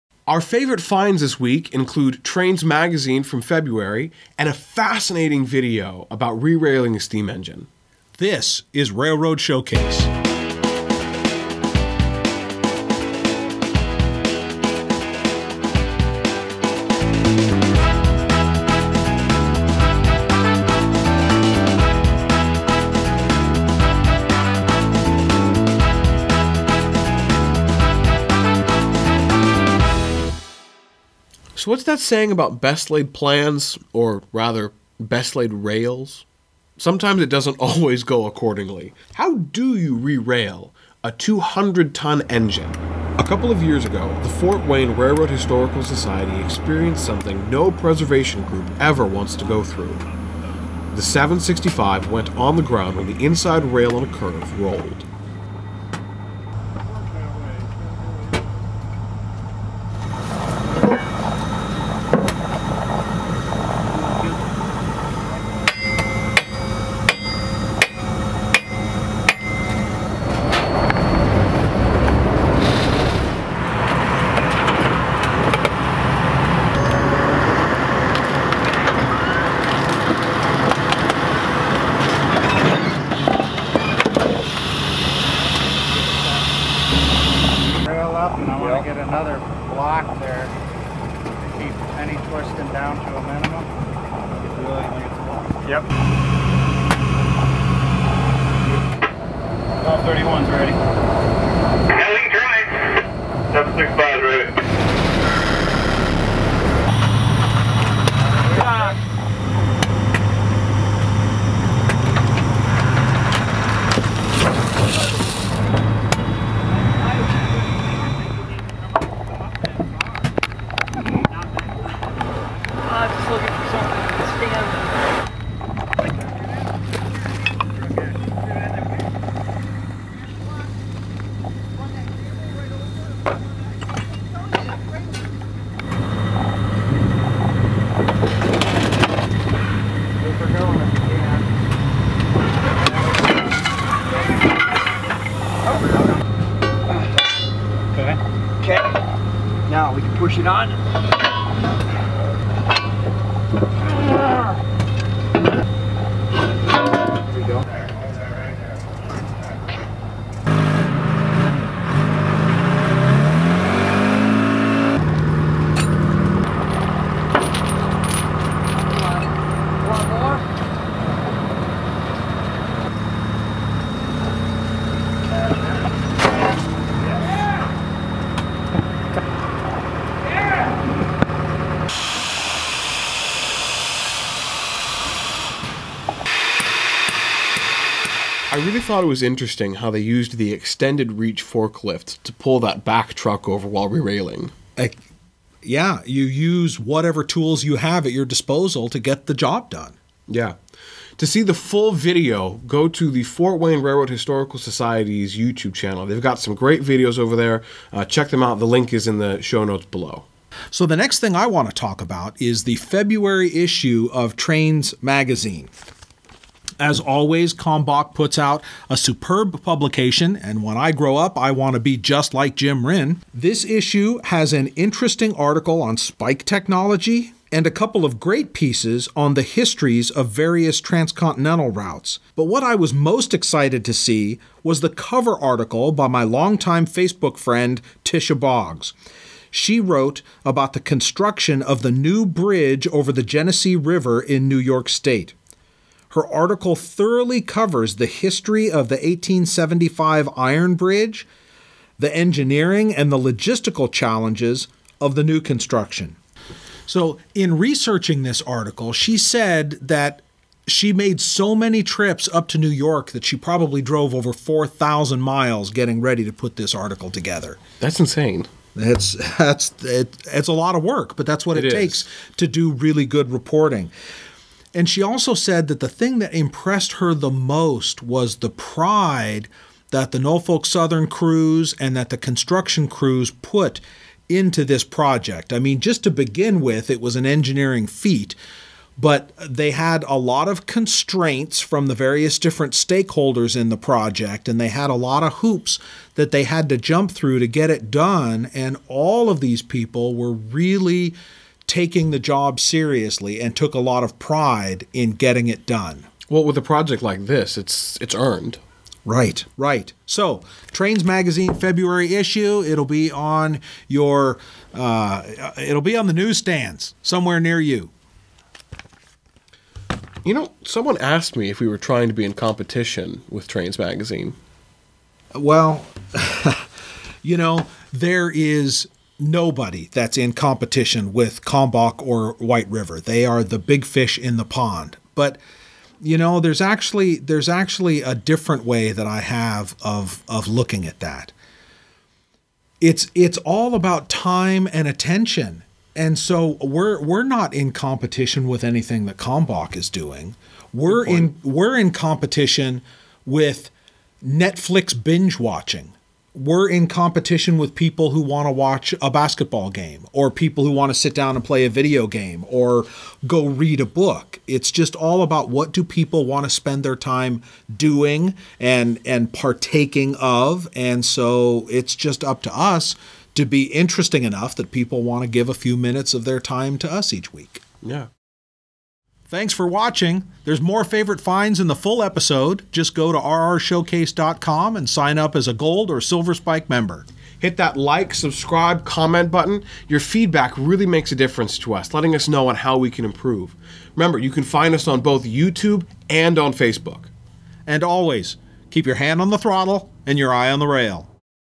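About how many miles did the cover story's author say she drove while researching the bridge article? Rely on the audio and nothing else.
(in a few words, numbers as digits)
4,000 miles.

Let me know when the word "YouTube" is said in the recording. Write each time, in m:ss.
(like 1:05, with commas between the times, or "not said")
3:25, 6:35.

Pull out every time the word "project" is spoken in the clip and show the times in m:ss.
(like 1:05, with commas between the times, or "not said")
4:44, 4:53, 5:06.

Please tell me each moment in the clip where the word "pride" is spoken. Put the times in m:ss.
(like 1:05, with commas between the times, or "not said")
4:38, 5:04.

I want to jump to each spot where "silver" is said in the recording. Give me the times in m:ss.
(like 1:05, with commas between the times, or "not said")
6:26.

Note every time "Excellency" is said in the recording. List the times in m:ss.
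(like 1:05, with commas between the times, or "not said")
not said.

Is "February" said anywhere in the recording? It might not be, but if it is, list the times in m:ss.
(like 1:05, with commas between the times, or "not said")
0:03, 3:32, 5:11.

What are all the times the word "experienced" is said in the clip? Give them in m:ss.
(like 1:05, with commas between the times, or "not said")
0:46.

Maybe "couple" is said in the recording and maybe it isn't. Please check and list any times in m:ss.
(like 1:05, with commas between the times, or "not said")
0:43, 3:47.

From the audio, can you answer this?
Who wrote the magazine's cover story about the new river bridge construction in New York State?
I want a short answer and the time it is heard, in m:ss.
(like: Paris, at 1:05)
Tisha Boggs, at 3:58.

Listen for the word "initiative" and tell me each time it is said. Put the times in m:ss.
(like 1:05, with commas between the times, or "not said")
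not said.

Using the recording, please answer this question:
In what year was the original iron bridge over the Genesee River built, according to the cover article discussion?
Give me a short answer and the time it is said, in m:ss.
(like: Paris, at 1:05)
1875, at 4:08.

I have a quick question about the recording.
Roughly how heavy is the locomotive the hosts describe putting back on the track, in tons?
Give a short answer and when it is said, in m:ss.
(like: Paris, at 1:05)
200 tons, at 0:41.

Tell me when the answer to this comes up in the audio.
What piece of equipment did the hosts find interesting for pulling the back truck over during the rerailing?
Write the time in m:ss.
3:10.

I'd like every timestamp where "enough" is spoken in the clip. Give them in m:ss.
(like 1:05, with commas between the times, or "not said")
6:14.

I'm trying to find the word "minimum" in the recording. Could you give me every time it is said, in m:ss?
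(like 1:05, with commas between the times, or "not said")
1:33.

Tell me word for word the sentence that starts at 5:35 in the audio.
But you know, there's actually there's actually a different way that I have of of looking at that.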